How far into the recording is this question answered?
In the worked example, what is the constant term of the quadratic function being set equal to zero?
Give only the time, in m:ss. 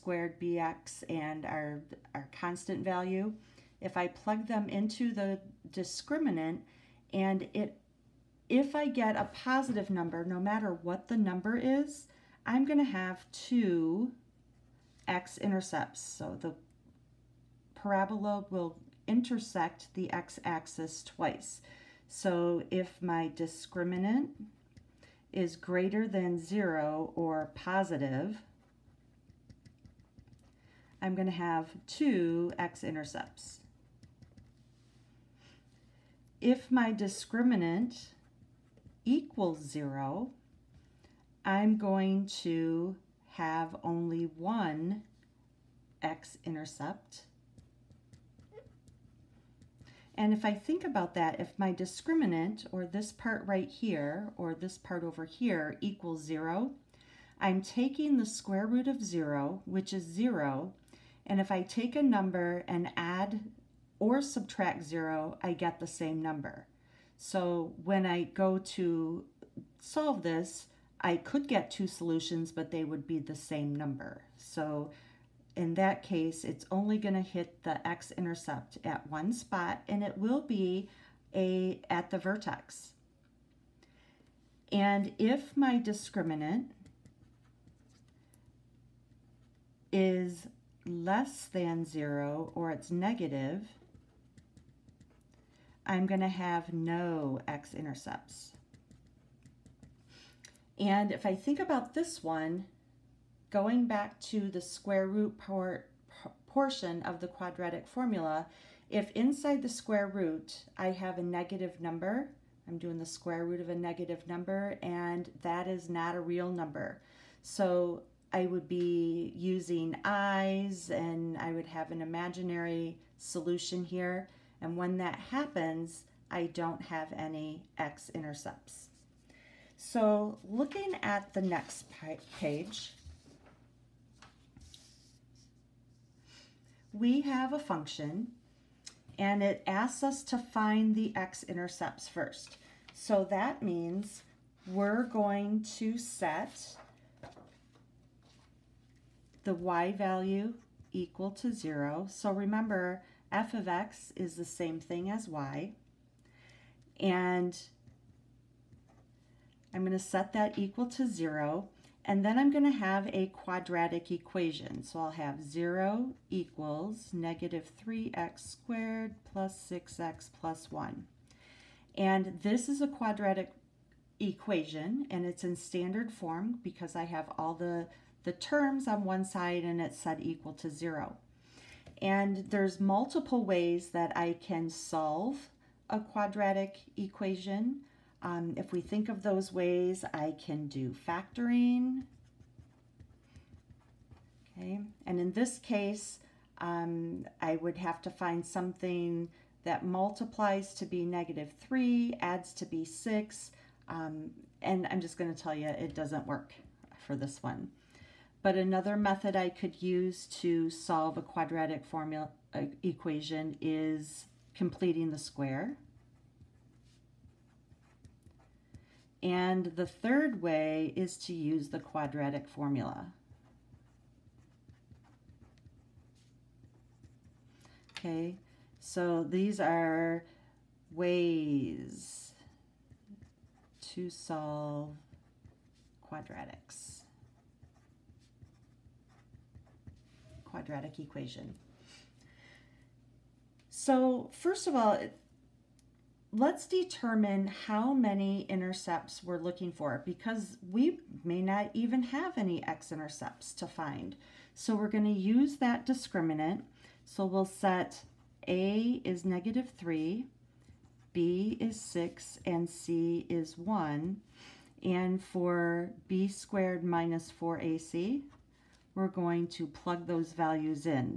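2:50.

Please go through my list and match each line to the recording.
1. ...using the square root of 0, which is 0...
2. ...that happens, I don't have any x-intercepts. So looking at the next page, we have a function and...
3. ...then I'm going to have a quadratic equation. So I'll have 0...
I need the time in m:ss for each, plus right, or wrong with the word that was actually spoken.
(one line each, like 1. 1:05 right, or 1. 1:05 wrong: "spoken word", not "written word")
1. 0:57 wrong: "taking", not "using"
2. 2:04 right
3. 2:42 right.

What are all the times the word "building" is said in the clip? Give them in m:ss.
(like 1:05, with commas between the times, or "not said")
not said.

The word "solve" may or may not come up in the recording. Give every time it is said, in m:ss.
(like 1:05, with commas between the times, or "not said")
1:09, 3:04, 3:30, 3:54.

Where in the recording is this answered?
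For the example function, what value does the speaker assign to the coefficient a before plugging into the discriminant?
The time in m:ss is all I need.
4:18.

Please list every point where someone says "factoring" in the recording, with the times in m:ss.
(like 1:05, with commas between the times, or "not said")
3:11.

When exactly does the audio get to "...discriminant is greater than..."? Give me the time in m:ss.
0:23.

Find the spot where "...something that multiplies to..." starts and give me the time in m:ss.
3:18.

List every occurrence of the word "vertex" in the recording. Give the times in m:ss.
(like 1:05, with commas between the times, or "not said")
1:22.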